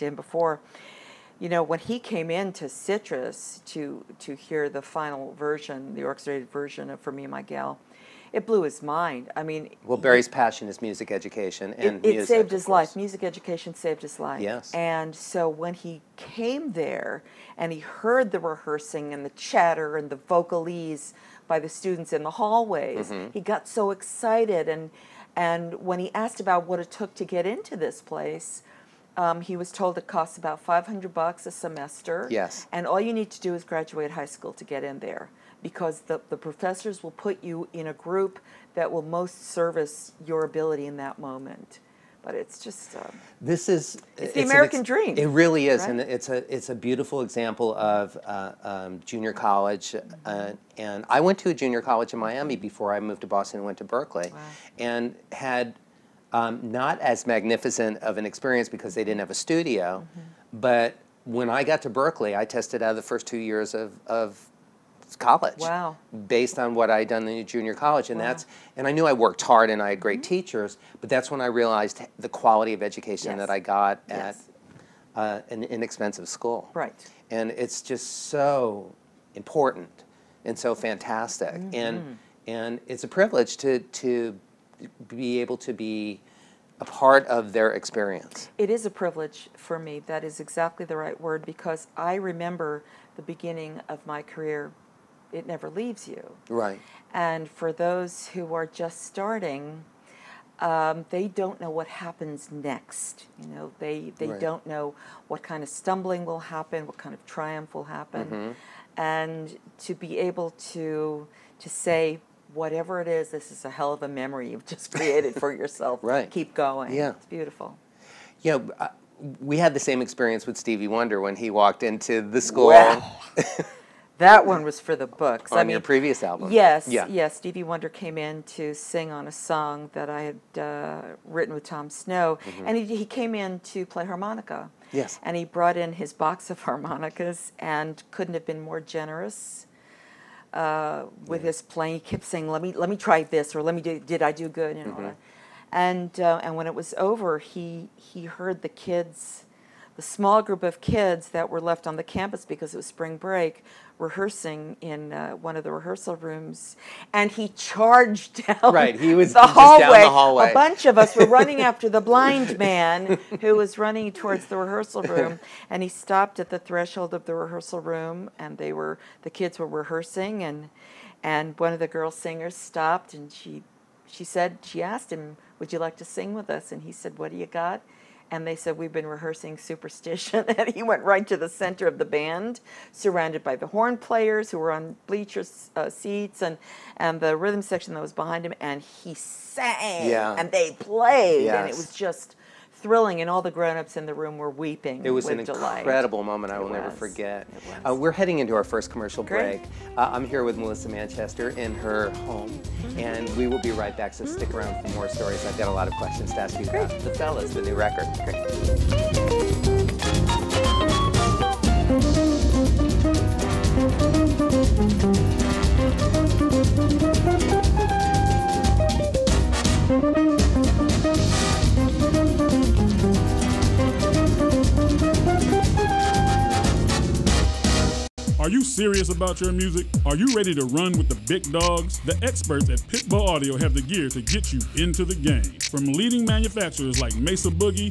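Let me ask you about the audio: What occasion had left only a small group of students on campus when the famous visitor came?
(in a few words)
Spring break.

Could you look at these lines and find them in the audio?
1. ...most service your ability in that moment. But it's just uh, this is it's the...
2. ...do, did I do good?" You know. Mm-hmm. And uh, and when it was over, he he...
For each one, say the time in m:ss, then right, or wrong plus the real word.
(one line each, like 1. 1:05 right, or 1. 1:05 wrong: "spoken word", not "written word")
1. 0:39 right
2. 2:23 right.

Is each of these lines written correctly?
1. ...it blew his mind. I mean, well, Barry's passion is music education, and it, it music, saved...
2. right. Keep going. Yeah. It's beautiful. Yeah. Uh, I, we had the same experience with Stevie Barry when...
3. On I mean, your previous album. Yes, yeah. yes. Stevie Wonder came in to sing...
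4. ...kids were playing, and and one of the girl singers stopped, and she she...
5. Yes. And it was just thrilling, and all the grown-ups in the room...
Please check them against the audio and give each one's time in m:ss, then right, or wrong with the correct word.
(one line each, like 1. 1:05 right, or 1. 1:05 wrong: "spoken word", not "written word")
1. 0:08 right
2. 1:56 wrong: "Wonder", not "Barry"
3. 2:05 right
4. 2:49 wrong: "rehearsing", not "playing"
5. 3:11 right.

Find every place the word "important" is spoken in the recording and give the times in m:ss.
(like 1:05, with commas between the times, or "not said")
1:19.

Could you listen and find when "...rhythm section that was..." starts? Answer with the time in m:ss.
3:07.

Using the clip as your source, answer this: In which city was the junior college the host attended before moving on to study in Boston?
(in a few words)
Miami.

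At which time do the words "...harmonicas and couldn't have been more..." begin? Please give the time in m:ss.
2:16.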